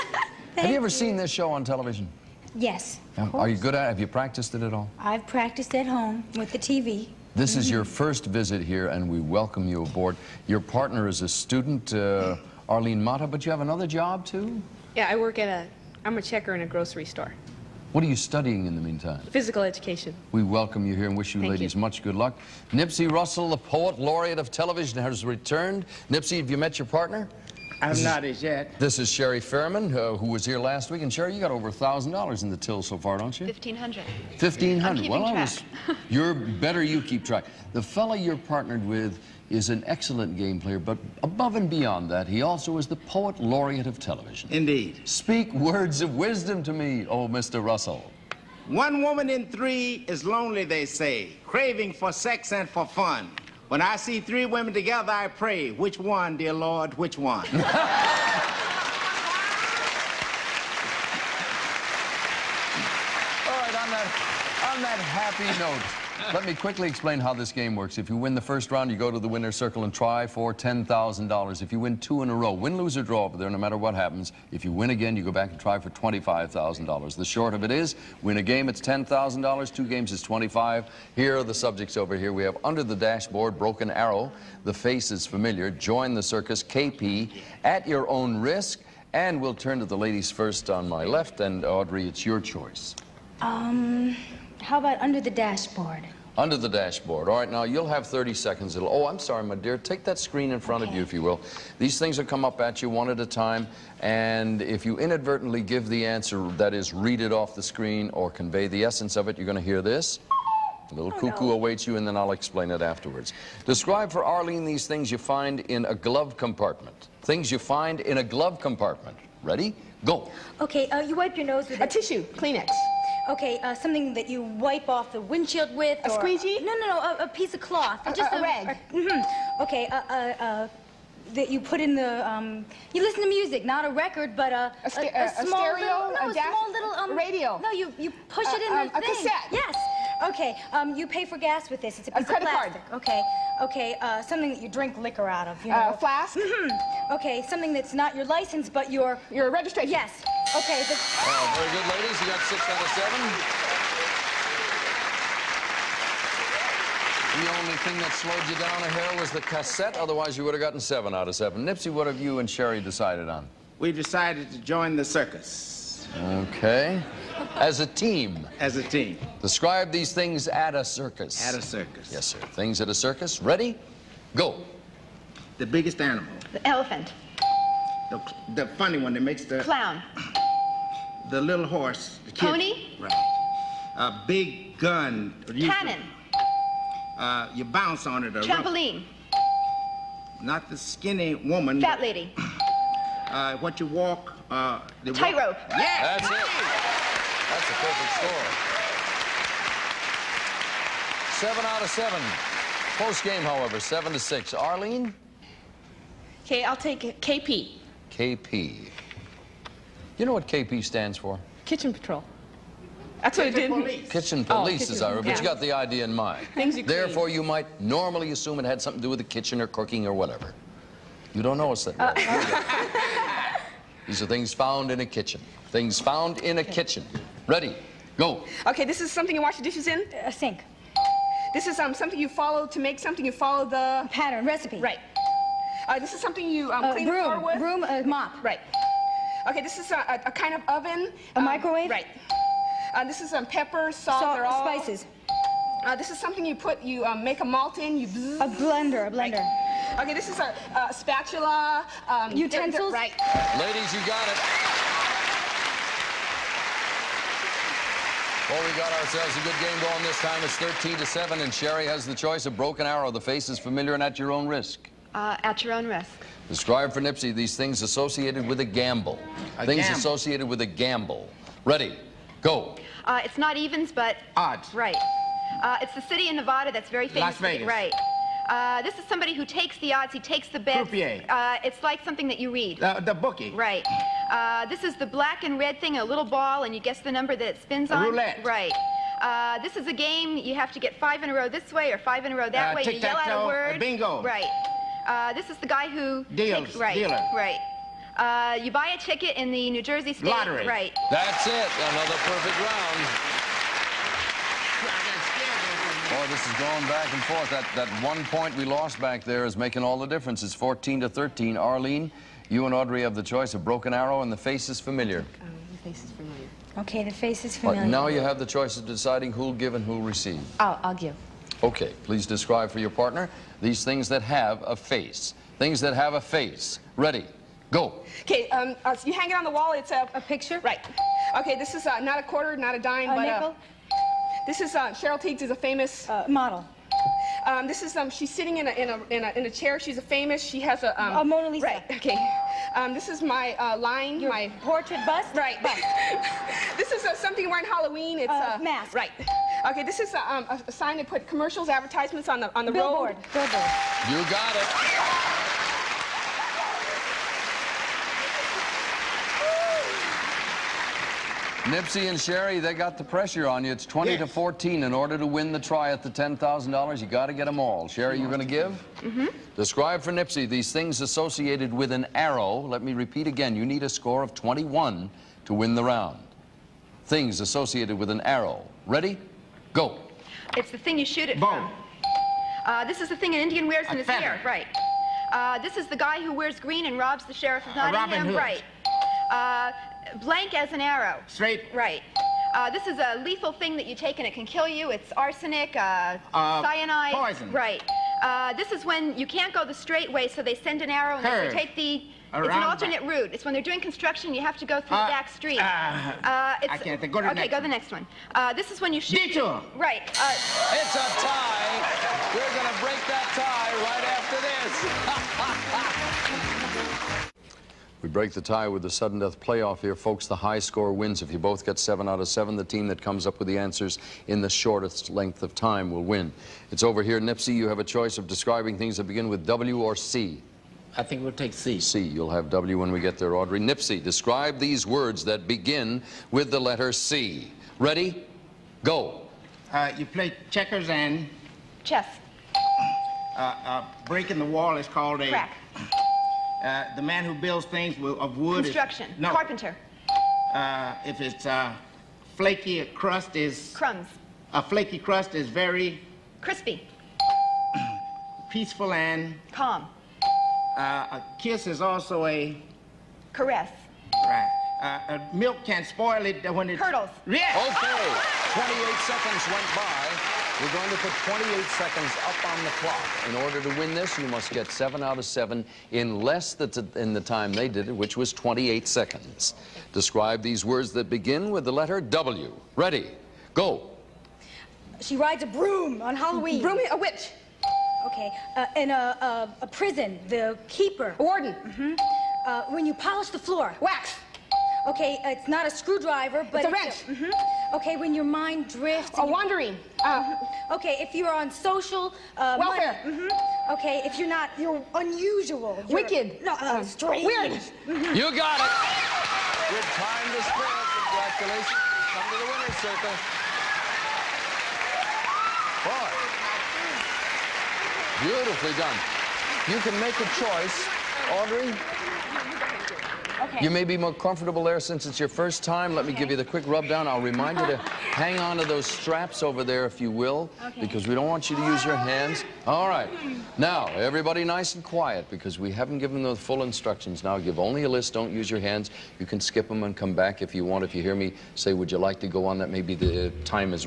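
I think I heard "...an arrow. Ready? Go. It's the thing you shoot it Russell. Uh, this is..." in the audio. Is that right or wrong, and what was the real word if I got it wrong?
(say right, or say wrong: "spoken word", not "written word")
wrong: "Bow", not "Russell".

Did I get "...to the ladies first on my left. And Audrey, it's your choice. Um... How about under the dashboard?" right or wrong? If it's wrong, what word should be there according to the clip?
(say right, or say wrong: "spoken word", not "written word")
right.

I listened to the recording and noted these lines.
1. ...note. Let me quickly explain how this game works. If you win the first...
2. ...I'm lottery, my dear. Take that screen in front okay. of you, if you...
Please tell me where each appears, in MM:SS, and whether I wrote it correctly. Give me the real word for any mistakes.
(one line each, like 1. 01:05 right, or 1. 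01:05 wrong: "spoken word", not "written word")
1. 01:05 right
2. 01:39 wrong: "sorry", not "lottery".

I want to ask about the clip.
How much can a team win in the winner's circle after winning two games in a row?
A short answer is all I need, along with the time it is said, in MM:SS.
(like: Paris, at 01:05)
$25,000, at 01:15.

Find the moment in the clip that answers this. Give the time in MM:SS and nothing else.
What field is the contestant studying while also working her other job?
00:19.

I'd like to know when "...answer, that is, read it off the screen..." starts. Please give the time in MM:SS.
01:46.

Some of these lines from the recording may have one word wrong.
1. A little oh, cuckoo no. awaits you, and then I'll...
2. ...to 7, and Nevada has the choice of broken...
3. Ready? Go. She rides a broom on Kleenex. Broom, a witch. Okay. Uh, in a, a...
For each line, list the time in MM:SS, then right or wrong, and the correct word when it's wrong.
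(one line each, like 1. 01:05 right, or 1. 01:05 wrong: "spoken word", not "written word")
1. 01:50 right
2. 04:20 wrong: "Sherry", not "Nevada"
3. 08:02 wrong: "Halloween", not "Kleenex".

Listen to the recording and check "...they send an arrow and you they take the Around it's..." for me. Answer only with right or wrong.
right.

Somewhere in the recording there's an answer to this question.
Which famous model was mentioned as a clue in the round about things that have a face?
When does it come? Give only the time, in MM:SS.
05:34.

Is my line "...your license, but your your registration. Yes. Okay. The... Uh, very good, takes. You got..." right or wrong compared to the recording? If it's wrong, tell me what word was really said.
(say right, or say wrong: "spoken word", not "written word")
wrong: "ladies", not "takes".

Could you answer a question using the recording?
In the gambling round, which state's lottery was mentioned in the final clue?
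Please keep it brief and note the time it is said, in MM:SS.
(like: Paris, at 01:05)
New Jersey, at 04:59.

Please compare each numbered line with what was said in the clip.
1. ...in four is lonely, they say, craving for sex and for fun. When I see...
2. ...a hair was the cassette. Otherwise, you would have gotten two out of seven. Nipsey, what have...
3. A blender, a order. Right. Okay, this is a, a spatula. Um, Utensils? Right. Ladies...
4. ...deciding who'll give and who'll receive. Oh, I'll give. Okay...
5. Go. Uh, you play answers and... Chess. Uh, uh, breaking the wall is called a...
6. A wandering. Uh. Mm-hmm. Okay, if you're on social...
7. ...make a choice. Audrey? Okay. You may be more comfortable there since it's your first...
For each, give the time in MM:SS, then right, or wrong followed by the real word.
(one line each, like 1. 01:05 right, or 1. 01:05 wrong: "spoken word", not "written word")
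1. 00:49 wrong: "three", not "four"
2. 02:38 wrong: "seven", not "two"
3. 04:08 wrong: "blender", not "order"
4. 05:18 right
5. 07:18 wrong: "checkers", not "answers"
6. 08:19 right
7. 08:39 right.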